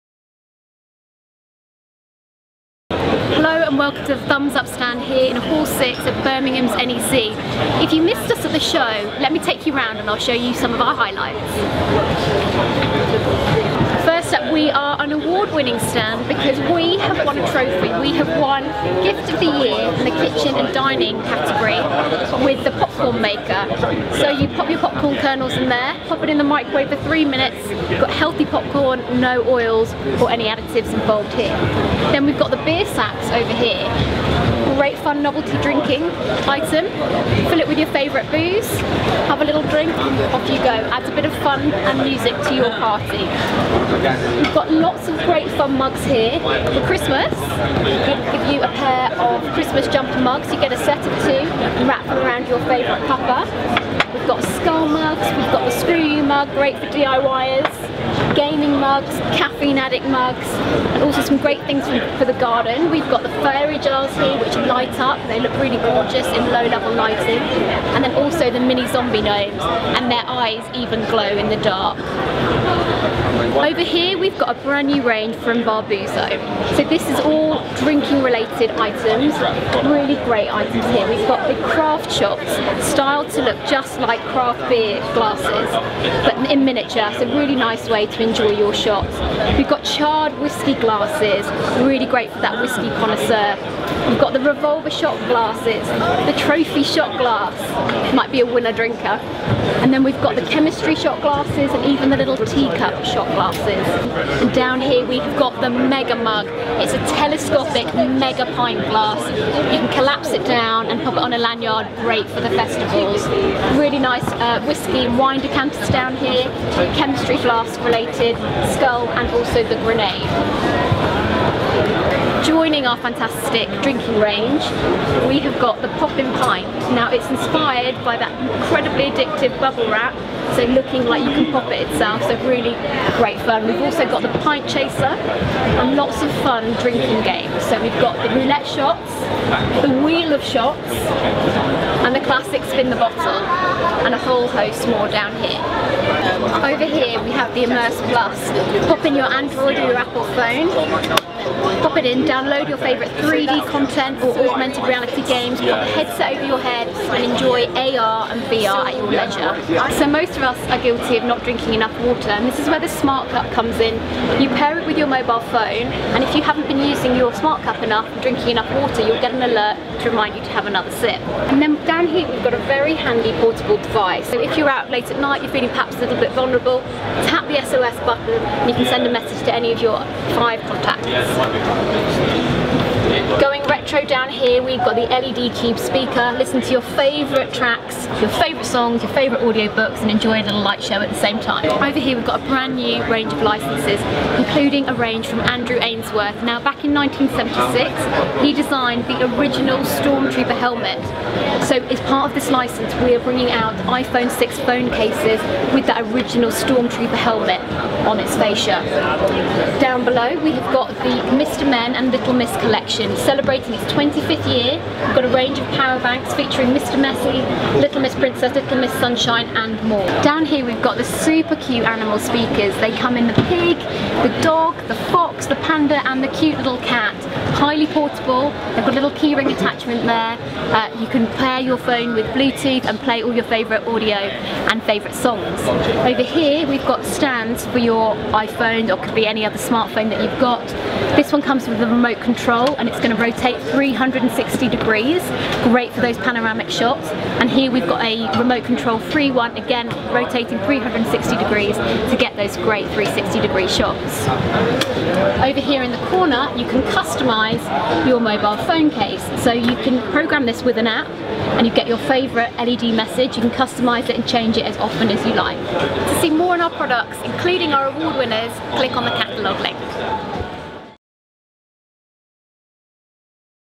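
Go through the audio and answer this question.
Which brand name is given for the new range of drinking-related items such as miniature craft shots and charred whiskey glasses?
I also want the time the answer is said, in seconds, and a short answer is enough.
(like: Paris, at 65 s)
Barbuzzo, at 75 s.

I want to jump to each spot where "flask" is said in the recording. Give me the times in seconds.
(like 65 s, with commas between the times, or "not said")
117 s.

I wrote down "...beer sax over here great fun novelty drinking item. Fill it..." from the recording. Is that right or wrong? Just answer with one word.
right.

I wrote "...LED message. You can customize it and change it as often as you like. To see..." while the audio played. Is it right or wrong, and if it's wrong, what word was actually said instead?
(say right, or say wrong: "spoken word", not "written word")
right.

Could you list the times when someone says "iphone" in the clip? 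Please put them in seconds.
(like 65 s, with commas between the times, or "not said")
203 s, 238 s.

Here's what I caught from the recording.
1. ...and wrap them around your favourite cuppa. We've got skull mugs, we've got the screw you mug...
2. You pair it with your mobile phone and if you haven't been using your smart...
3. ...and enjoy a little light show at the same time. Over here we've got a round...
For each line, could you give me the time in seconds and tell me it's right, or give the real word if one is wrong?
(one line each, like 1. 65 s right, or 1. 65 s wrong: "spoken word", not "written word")
1. 51 s right
2. 164 s right
3. 190 s wrong: "brand", not "round".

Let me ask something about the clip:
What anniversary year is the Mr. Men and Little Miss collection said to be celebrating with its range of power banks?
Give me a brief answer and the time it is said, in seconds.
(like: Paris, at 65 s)
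25th, at 213 s.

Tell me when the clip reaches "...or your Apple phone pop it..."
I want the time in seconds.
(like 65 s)
149 s.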